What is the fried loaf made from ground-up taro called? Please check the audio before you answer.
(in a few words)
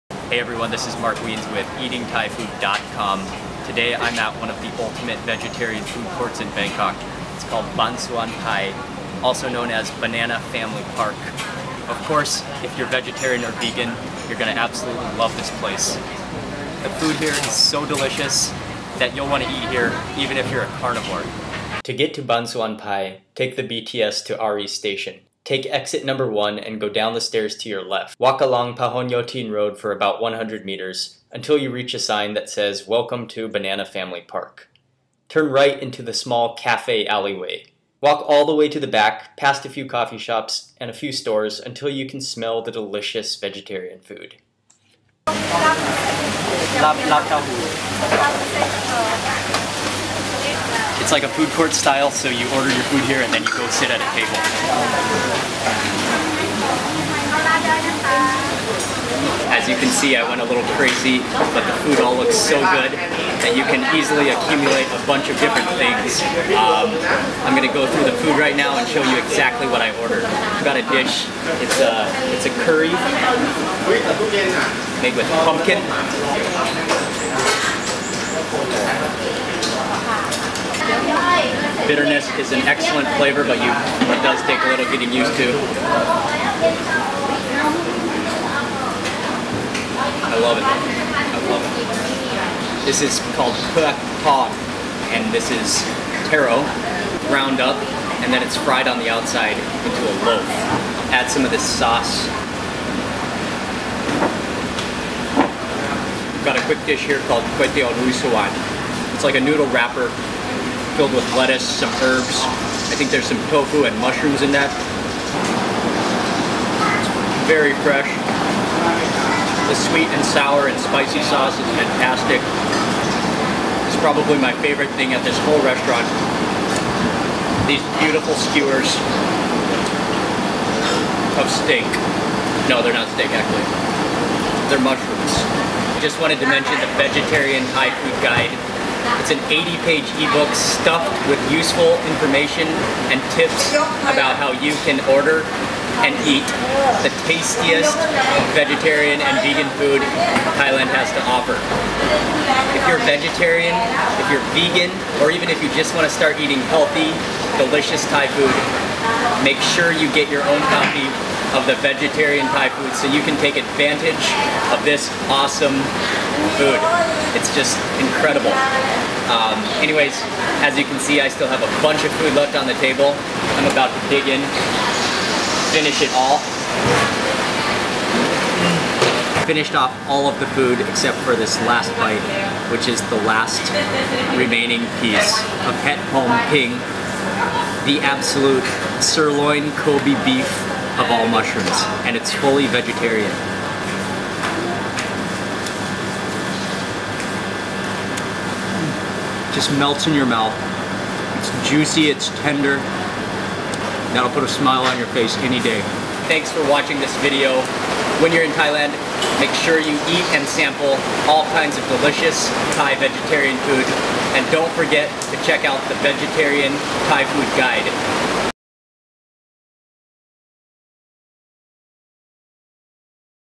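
Pod.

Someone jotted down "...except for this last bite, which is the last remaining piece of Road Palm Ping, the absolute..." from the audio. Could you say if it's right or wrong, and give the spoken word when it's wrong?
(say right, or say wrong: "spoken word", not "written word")
wrong: "Het", not "Road".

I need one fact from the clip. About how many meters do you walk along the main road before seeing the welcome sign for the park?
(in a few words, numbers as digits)
100.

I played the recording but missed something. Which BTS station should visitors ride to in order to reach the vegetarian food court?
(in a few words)
Ari Station.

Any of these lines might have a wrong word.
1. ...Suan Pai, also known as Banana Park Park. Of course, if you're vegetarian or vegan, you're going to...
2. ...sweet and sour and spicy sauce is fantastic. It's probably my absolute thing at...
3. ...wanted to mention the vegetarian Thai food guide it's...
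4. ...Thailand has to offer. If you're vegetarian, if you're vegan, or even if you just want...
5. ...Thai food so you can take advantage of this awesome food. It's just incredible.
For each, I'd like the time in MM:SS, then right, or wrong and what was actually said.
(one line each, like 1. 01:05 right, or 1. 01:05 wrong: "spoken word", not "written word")
1. 00:07 wrong: "Family", not "Park"
2. 01:59 wrong: "favorite", not "absolute"
3. 02:16 right
4. 02:30 right
5. 02:42 right.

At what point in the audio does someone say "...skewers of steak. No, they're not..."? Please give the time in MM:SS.
02:08.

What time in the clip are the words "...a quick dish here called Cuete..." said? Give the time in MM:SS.
01:46.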